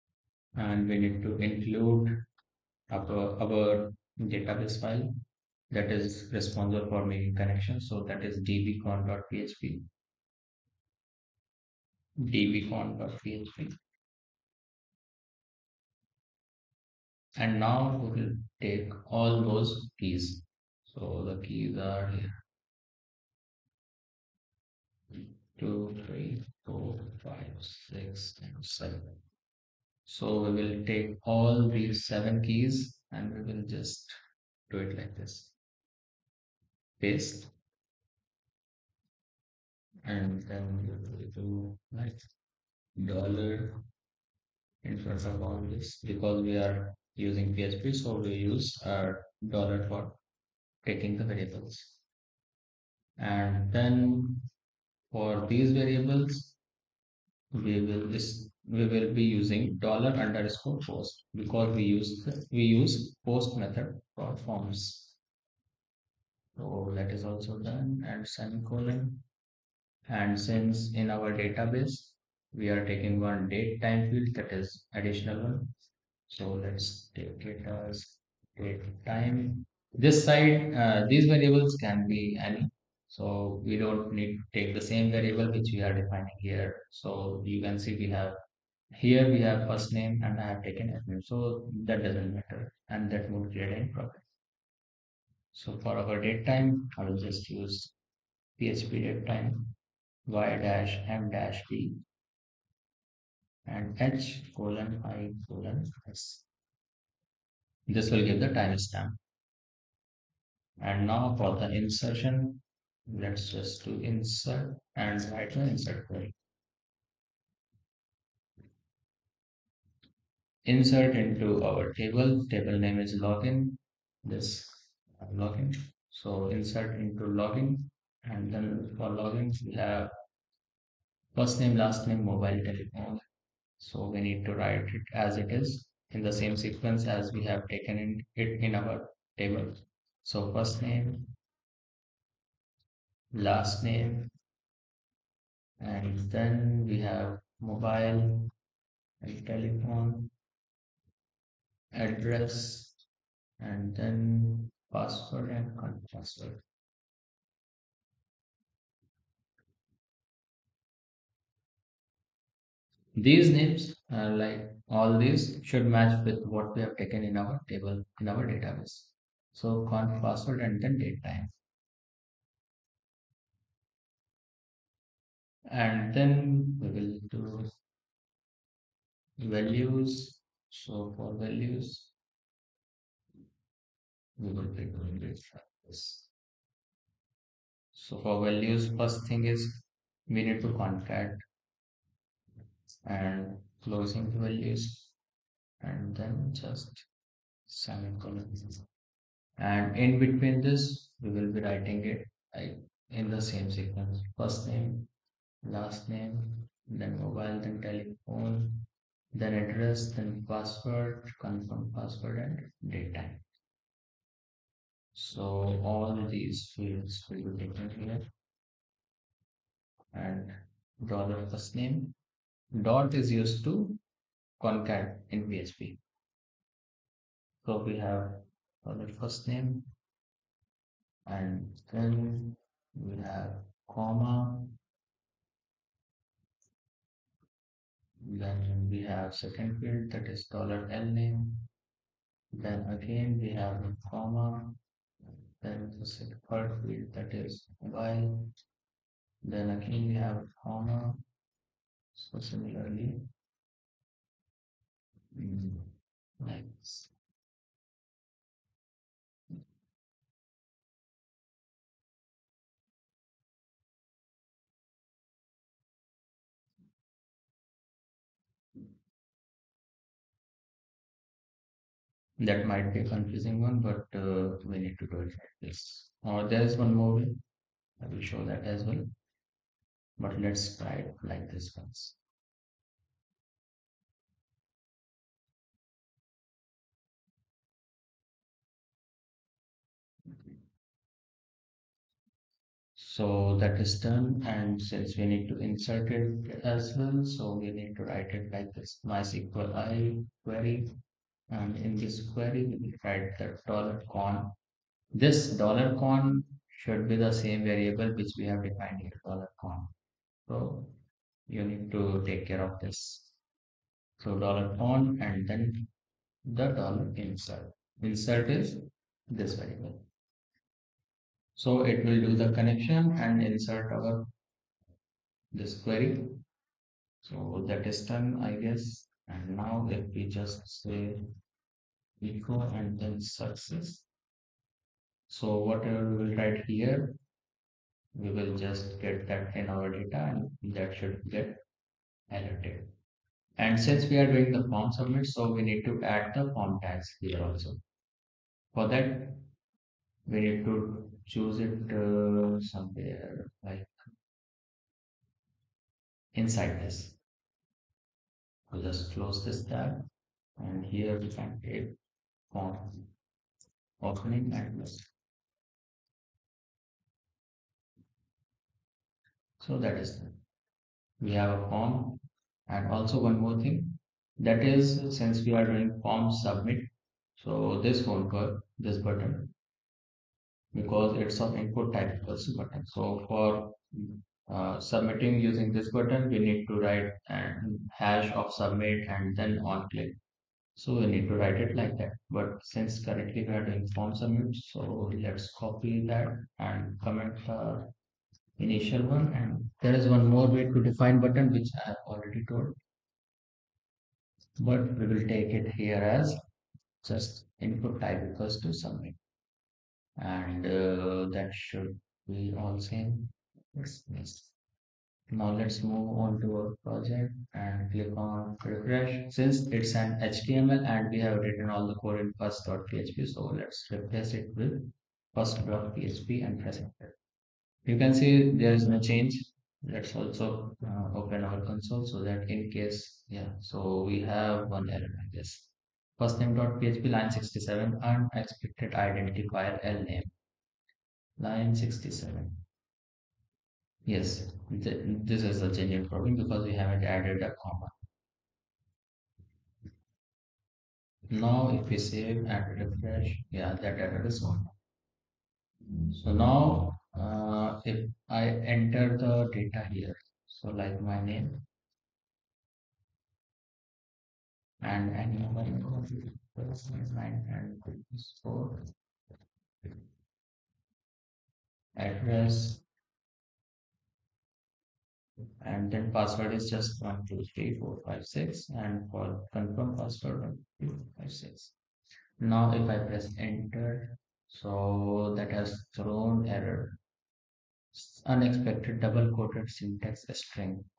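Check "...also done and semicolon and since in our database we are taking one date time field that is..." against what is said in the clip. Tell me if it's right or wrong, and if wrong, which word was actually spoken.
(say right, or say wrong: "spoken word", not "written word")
right.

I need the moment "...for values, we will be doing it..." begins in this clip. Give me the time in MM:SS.
03:01.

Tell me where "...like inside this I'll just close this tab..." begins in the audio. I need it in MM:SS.
05:53.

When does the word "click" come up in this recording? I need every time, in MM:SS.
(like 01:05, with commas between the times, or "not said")
06:29, 06:57.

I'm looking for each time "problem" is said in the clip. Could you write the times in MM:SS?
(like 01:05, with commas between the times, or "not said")
01:33, 07:26.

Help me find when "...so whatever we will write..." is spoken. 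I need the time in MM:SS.
05:35.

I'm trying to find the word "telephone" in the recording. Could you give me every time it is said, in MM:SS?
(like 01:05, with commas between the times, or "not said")
02:12, 02:29, 03:27.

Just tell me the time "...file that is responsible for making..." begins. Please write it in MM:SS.
00:04.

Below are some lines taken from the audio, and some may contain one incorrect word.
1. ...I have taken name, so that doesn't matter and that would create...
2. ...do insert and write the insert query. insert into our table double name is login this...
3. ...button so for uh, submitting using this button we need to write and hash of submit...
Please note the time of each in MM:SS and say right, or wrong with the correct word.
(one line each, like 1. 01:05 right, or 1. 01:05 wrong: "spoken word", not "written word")
1. 01:30 right
2. 01:53 wrong: "table", not "double"
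3. 06:22 right.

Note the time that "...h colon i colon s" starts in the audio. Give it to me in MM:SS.
01:44.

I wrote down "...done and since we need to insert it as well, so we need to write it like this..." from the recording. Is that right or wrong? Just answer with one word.
right.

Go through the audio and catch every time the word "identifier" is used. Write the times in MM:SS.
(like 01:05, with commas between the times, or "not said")
07:18.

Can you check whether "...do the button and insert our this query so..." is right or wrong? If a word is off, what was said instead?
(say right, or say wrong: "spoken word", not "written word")
wrong: "connection", not "button".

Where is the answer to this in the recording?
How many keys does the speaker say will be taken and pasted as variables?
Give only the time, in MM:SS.
00:32.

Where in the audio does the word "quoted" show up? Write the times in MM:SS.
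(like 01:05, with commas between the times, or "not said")
08:09.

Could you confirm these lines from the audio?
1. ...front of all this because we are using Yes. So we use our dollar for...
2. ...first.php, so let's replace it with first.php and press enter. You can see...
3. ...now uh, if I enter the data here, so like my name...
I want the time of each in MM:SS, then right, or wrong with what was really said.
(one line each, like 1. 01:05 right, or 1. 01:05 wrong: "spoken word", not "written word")
1. 00:44 wrong: "PHP", not "Yes"
2. 07:02 right
3. 07:36 right.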